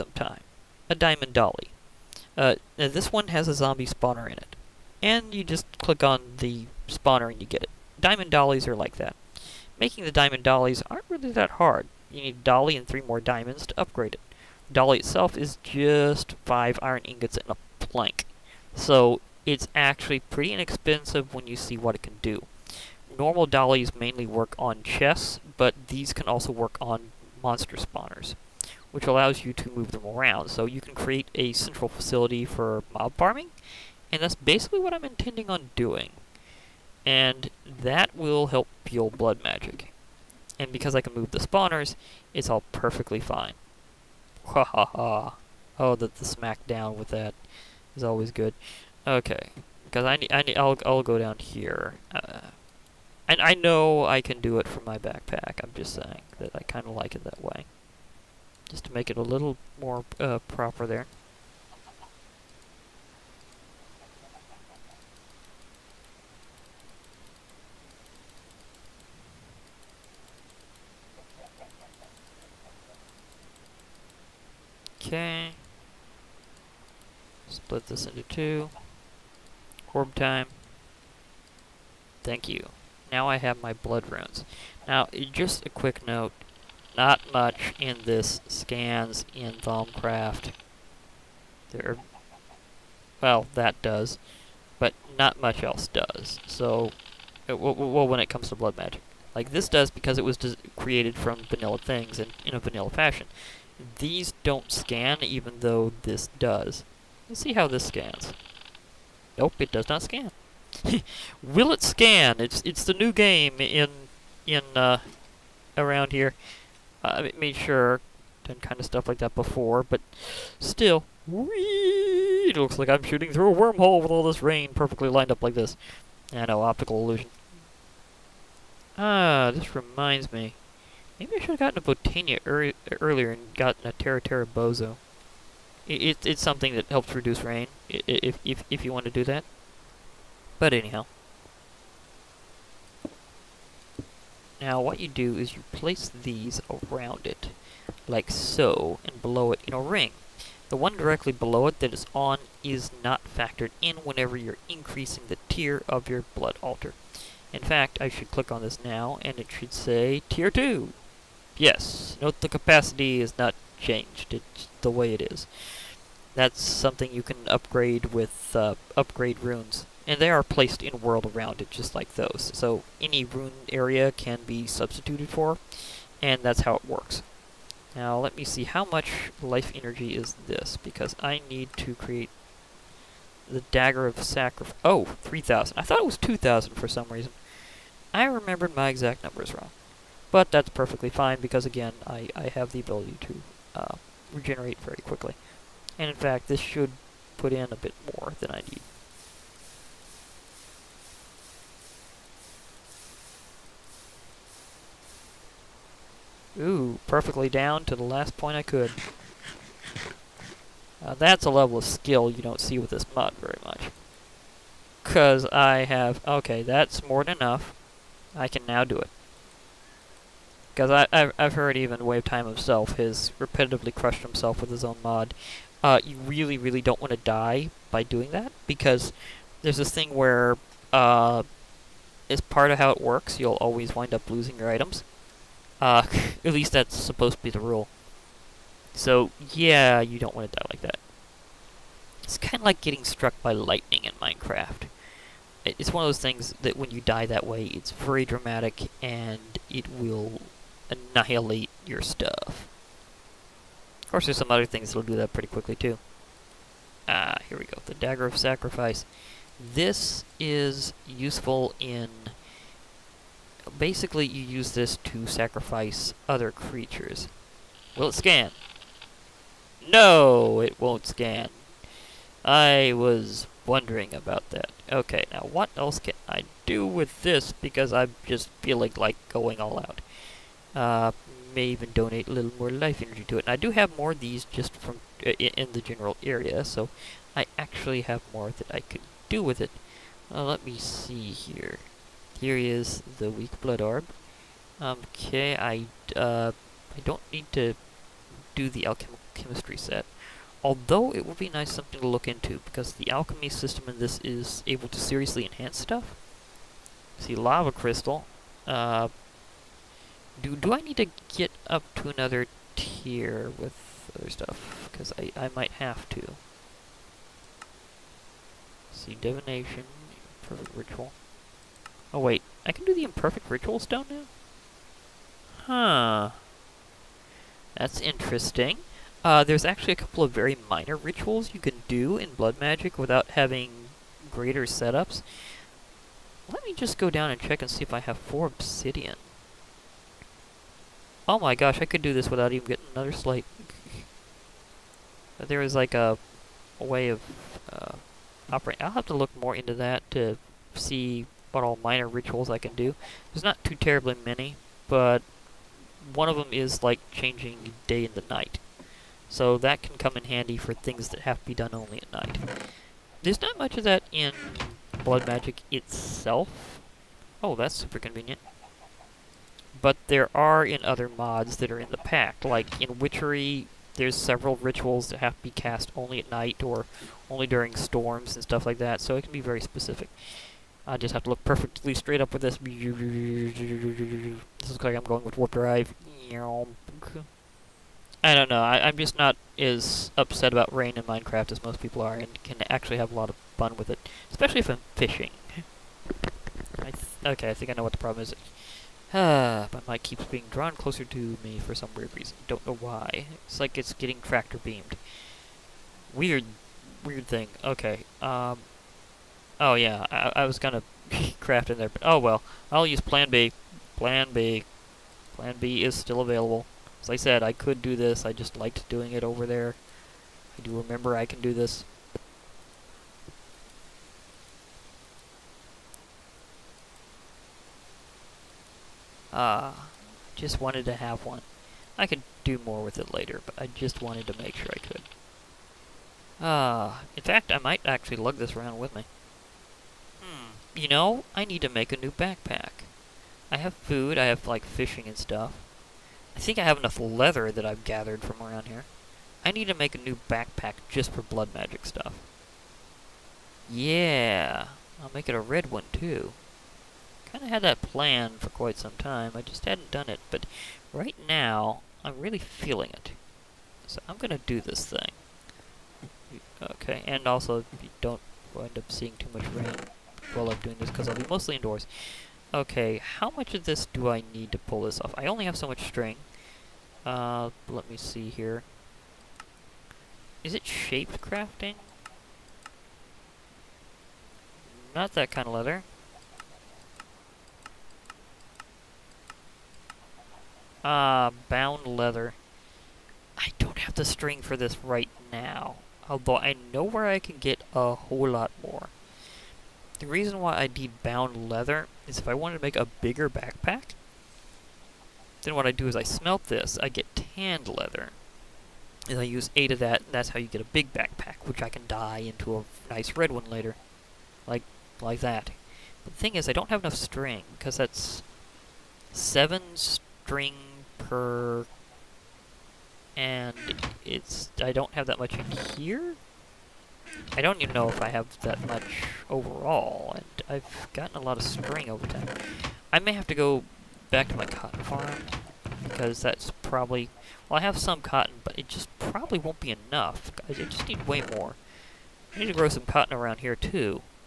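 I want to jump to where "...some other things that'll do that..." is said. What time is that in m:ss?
4:14.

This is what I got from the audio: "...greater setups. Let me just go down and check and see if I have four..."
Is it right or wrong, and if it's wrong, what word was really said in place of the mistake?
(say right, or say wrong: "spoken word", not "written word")
right.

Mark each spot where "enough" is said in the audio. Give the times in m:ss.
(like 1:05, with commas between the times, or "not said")
3:37, 7:26, 8:36, 8:59.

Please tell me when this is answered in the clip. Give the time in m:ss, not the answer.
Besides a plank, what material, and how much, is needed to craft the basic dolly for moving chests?
0:16.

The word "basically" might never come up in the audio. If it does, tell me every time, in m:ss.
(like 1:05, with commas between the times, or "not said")
0:34, 4:23.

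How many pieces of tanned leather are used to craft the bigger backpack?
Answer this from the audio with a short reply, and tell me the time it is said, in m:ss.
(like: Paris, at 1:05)
8, at 8:29.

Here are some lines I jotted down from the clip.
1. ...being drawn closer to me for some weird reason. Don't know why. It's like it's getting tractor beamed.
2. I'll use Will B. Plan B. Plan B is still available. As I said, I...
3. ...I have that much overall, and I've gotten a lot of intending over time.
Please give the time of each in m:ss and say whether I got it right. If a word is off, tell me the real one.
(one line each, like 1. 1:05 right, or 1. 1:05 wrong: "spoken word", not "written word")
1. 6:40 right
2. 6:52 wrong: "Plan", not "Will"
3. 8:48 wrong: "string", not "intending".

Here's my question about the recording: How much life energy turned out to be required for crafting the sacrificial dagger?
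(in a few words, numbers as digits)
3,000.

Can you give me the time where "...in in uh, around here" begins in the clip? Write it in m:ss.
1:53.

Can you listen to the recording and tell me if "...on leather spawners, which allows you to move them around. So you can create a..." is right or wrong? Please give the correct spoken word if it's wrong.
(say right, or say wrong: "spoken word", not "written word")
wrong: "monster", not "leather".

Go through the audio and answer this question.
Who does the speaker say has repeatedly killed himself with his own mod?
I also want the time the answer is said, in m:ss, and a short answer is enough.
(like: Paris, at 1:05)
WayofTime, at 3:42.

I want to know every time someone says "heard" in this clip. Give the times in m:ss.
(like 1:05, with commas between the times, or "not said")
3:41.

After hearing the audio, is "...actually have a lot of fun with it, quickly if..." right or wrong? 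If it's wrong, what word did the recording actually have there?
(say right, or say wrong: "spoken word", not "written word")
wrong: "especially", not "quickly".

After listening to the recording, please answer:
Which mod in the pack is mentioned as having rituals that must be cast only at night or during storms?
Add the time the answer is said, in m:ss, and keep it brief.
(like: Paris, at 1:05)
Witchery, at 6:12.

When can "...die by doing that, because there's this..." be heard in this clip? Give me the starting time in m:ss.
3:47.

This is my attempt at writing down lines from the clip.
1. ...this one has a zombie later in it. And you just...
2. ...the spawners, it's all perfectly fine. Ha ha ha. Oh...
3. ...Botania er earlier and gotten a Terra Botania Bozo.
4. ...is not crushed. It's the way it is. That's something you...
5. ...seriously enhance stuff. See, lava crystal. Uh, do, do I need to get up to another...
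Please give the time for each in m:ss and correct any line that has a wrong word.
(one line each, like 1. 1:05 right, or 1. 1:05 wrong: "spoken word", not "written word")
1. 0:02 wrong: "spawner", not "later"
2. 0:41 right
3. 2:11 wrong: "Terra", not "Botania"
4. 2:43 wrong: "changed", not "crushed"
5. 5:04 right.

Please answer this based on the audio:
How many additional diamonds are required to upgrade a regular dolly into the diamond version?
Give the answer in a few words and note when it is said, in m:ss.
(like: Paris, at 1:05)
3, at 0:12.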